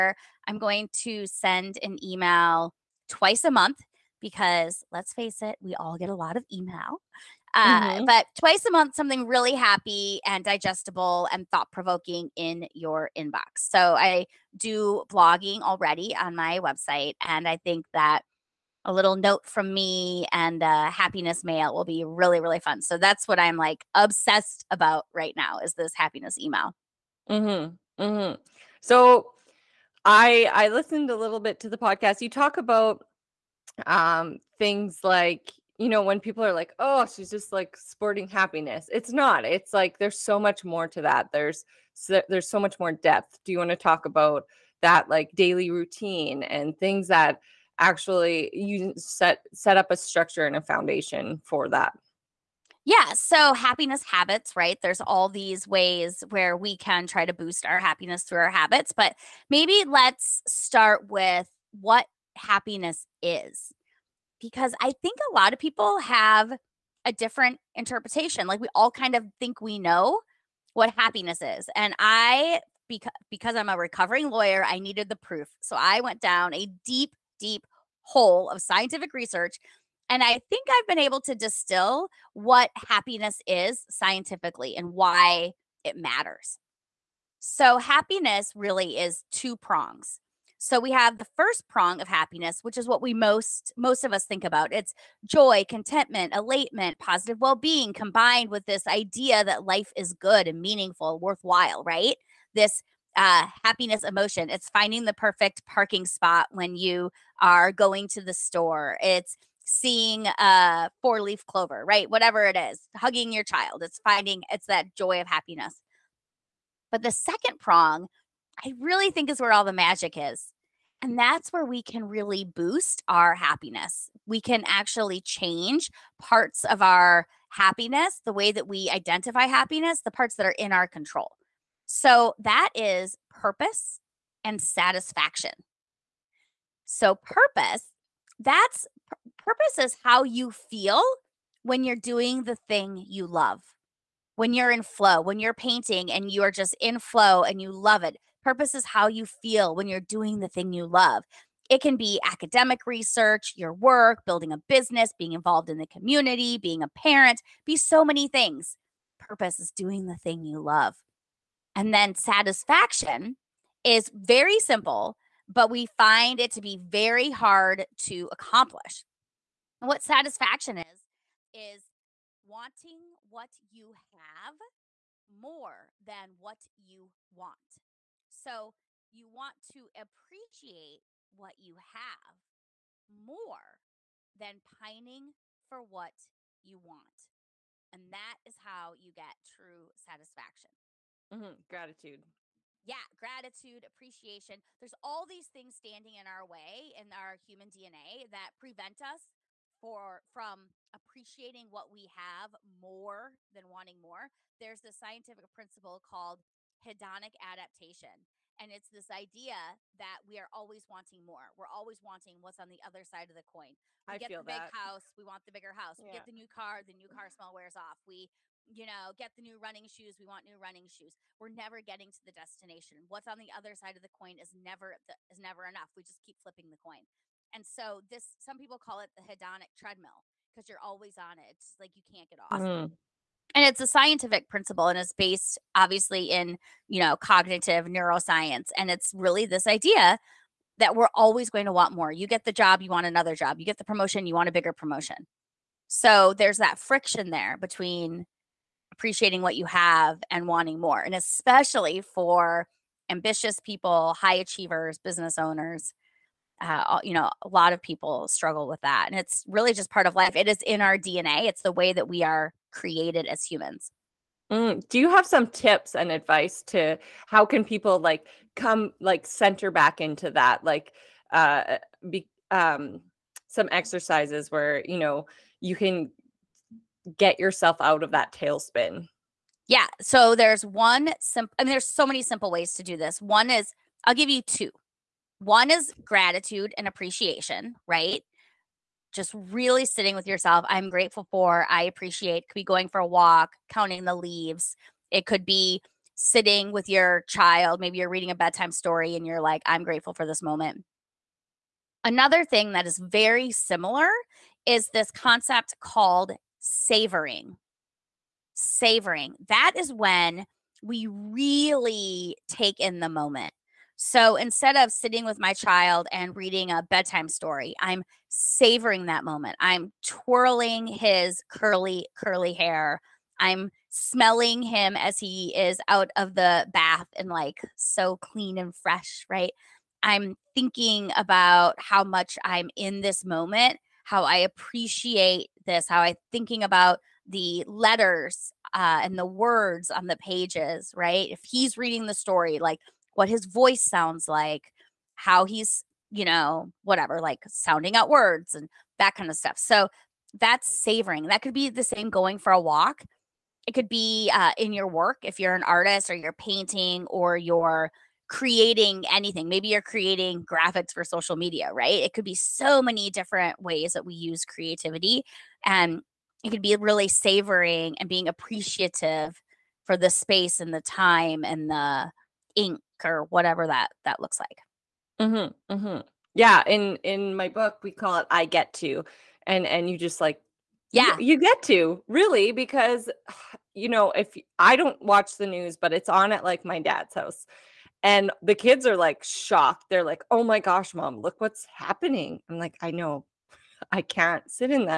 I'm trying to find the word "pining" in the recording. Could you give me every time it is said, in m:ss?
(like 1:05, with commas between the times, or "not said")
3:04.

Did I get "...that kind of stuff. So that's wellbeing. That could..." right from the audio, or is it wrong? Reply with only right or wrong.
wrong.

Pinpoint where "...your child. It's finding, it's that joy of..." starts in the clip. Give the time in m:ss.
1:53.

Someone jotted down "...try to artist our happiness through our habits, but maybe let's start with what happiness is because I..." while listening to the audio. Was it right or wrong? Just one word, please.
wrong.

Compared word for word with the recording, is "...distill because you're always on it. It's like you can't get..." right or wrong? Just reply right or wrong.
wrong.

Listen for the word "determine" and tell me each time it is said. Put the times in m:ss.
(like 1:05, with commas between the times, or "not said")
not said.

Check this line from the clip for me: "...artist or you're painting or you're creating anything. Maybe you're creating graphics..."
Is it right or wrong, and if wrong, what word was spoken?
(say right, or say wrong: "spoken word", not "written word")
right.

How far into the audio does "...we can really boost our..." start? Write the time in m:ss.
2:01.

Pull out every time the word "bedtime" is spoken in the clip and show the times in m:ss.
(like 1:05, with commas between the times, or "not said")
4:58, 5:16.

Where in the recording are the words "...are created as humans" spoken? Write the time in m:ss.
4:22.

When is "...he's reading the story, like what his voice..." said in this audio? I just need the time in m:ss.
5:41.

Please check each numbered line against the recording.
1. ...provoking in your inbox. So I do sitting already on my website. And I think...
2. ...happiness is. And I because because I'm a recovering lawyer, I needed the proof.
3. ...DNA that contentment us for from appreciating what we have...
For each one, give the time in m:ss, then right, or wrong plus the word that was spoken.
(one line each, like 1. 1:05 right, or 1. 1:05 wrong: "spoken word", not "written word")
1. 0:11 wrong: "blogging", not "sitting"
2. 1:10 right
3. 3:17 wrong: "prevent", not "contentment".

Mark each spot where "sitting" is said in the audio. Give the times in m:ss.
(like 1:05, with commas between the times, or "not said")
4:49, 4:56, 5:14.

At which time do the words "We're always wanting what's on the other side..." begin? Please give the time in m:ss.
3:31.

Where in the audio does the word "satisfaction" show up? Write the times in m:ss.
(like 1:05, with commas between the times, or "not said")
2:14, 2:42, 2:50, 3:09.